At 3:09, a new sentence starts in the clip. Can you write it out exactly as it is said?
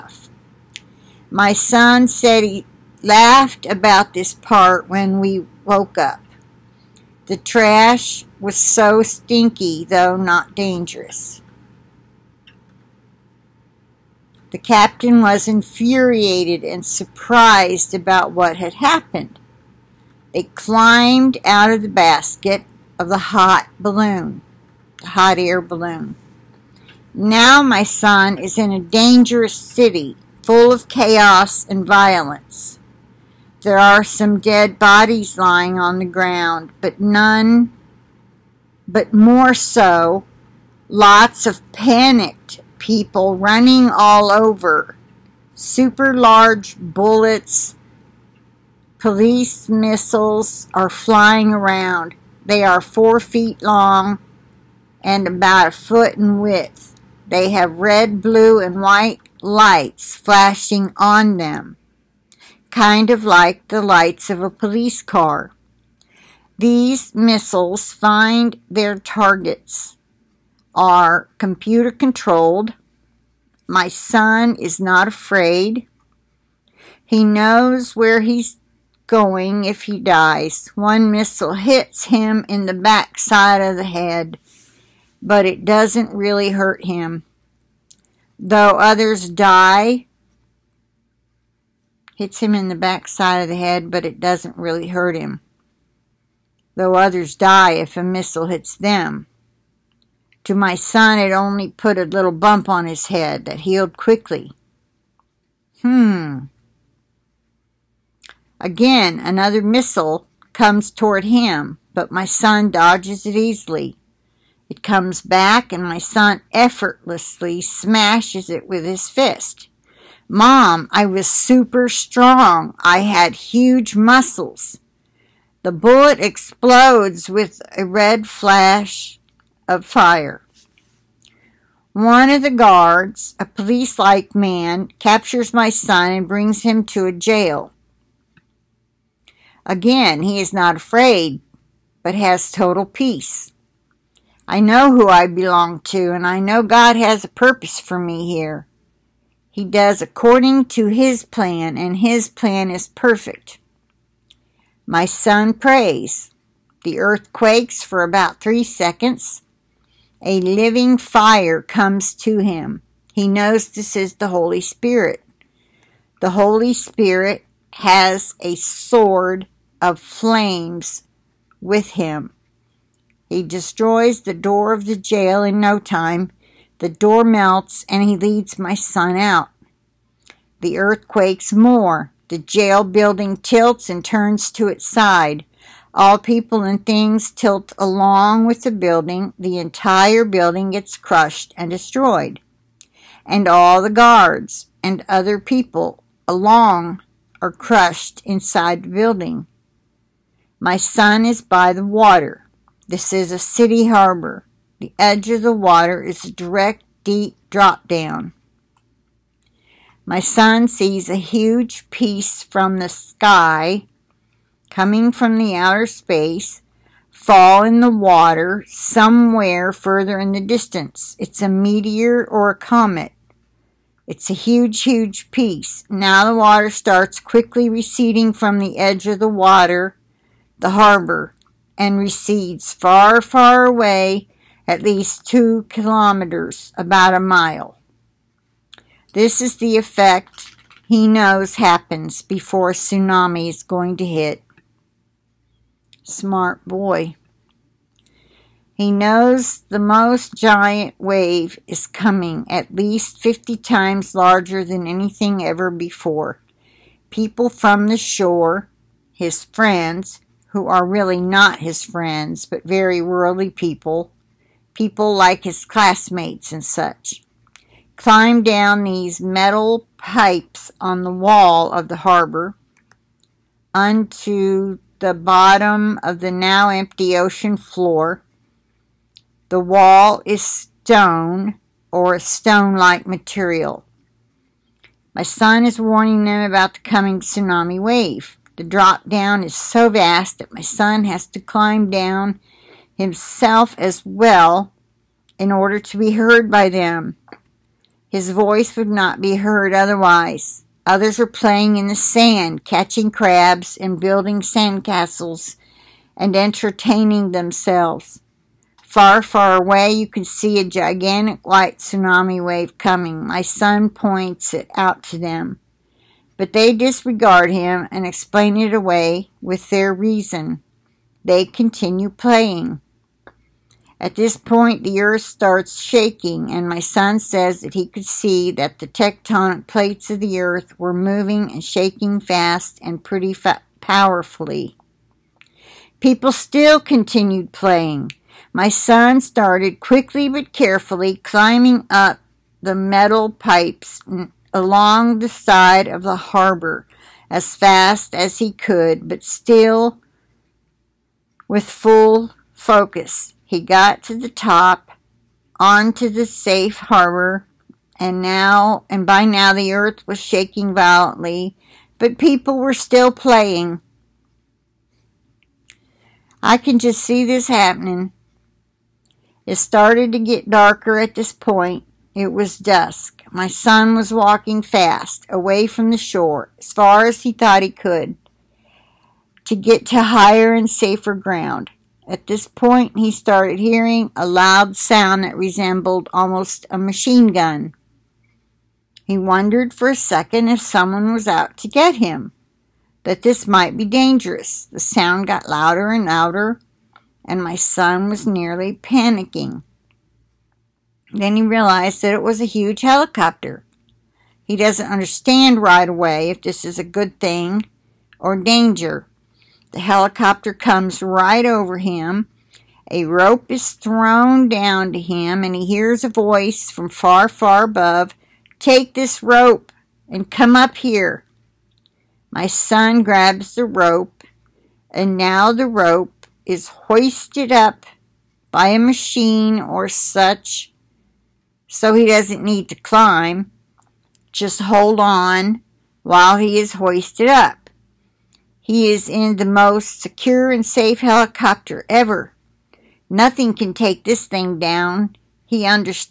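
The entire building gets crushed and destroyed.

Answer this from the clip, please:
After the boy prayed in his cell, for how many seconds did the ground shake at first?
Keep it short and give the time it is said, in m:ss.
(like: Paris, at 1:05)
3 seconds, at 2:38.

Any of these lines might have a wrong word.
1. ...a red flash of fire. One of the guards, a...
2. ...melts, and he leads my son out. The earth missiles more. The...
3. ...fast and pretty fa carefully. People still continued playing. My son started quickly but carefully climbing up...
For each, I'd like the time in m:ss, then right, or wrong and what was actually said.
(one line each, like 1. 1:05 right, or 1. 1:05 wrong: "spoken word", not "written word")
1. 2:07 right
2. 2:57 wrong: "quakes", not "missiles"
3. 5:32 wrong: "powerfully", not "carefully".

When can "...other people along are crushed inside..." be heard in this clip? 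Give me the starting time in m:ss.
3:15.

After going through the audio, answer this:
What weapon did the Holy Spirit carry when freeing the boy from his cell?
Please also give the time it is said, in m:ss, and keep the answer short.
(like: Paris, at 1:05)
sword of flames, at 2:48.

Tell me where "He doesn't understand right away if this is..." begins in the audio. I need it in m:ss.
6:44.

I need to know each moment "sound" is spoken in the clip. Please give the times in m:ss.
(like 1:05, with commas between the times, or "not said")
6:24, 6:34.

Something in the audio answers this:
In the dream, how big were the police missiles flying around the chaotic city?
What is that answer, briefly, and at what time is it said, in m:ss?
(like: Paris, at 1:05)
4 feet, at 0:52.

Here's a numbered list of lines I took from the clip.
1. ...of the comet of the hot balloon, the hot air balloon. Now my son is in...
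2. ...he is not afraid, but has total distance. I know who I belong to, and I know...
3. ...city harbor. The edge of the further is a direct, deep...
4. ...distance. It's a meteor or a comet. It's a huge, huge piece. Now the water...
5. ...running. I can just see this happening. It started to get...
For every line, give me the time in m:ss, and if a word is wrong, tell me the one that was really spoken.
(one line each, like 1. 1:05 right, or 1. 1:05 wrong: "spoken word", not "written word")
1. 0:21 wrong: "basket", not "comet"
2. 2:20 wrong: "peace", not "distance"
3. 3:23 wrong: "water", not "further"
4. 3:40 right
5. 6:03 wrong: "playing", not "running".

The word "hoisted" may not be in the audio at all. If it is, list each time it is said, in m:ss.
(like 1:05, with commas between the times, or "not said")
7:06, 7:16.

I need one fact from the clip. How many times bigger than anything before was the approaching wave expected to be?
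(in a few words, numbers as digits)
50.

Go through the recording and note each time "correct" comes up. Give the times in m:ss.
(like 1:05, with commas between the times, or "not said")
not said.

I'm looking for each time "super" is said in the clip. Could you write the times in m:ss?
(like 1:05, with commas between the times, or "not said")
0:45, 2:01.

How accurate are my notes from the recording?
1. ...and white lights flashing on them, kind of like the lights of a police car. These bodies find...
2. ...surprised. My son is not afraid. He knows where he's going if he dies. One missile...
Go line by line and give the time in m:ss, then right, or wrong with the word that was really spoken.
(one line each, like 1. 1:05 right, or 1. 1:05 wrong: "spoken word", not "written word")
1. 0:58 wrong: "missiles", not "bodies"
2. 1:11 wrong: "controlled", not "surprised".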